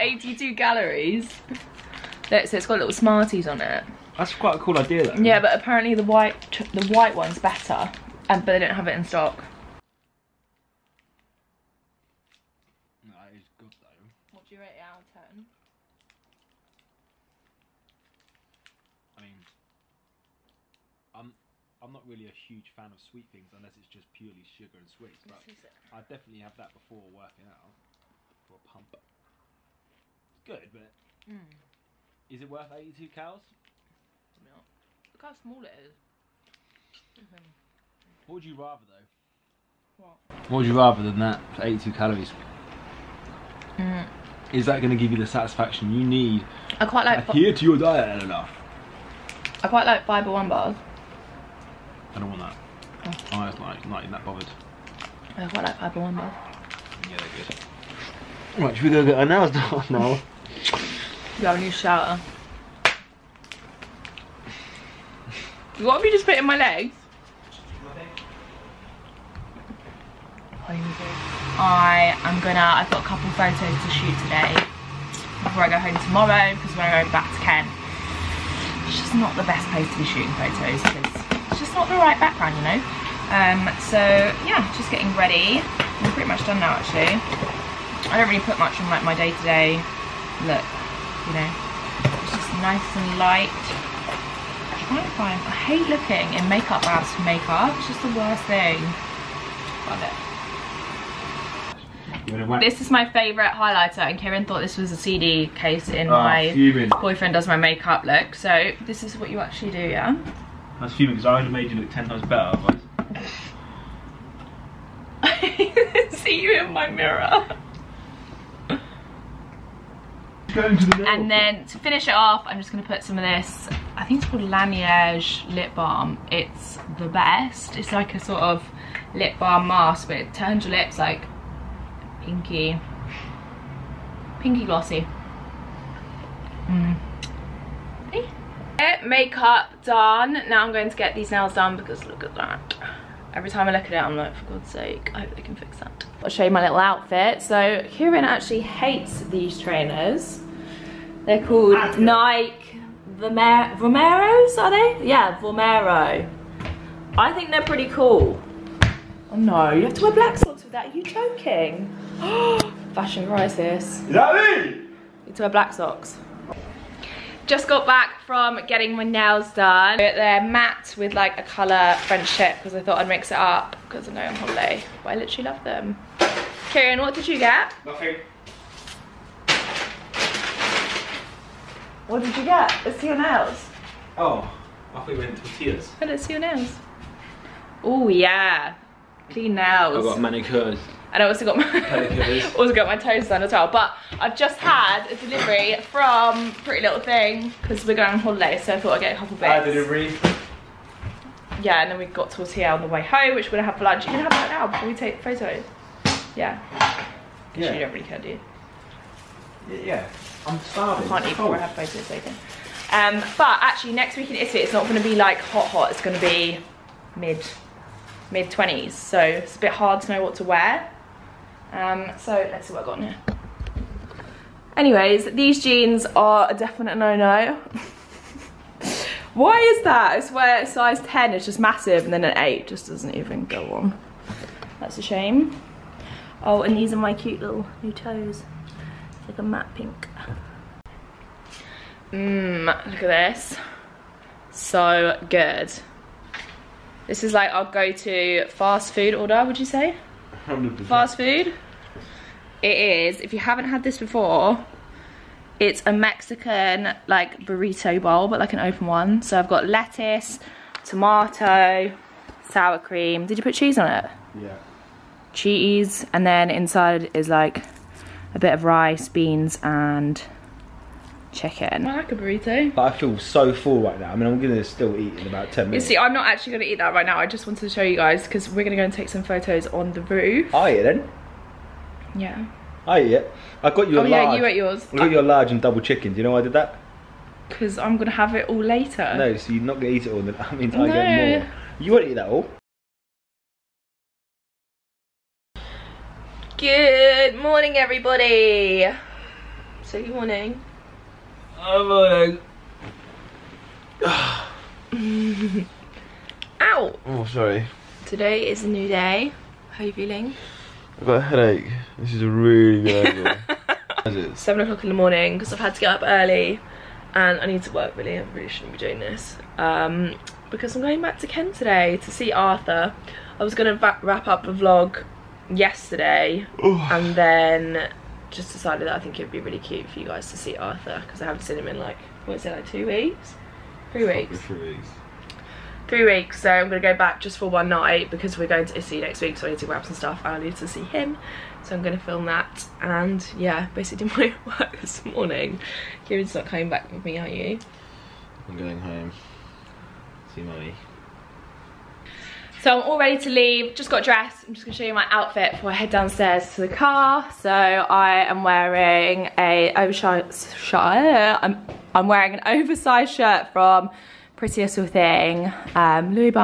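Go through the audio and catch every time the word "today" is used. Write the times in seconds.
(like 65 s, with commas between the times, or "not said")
74 s, 308 s, 321 s.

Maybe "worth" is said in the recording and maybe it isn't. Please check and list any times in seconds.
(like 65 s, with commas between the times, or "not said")
32 s.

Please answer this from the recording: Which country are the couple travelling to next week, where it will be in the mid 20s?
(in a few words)
Italy.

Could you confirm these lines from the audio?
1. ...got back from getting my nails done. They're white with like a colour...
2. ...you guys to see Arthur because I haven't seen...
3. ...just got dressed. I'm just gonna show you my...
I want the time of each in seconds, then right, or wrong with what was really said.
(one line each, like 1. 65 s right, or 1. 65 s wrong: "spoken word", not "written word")
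1. 167 s wrong: "matte", not "white"
2. 329 s right
3. 353 s right.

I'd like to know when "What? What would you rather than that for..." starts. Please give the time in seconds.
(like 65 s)
39 s.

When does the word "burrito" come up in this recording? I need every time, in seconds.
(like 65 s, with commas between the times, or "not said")
257 s, 272 s.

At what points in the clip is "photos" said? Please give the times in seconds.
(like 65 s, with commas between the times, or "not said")
73 s, 80 s, 205 s, 211 s, 279 s.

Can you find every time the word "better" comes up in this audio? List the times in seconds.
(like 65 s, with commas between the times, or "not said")
7 s, 112 s.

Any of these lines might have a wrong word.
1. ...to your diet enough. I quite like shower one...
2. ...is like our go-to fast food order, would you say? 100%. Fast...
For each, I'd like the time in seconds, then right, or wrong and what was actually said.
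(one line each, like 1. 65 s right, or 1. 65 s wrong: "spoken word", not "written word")
1. 47 s wrong: "fiber", not "shower"
2. 247 s right.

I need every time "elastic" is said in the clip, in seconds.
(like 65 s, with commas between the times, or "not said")
not said.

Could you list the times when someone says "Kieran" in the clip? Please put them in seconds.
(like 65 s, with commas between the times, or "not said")
104 s, 147 s, 176 s, 346 s.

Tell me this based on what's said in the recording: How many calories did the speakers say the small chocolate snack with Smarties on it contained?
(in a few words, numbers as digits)
82.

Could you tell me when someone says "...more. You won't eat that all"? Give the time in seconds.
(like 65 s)
291 s.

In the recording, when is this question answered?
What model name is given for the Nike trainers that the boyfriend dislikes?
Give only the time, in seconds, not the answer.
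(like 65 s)
155 s.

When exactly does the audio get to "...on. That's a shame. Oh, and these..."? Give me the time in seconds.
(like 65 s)
233 s.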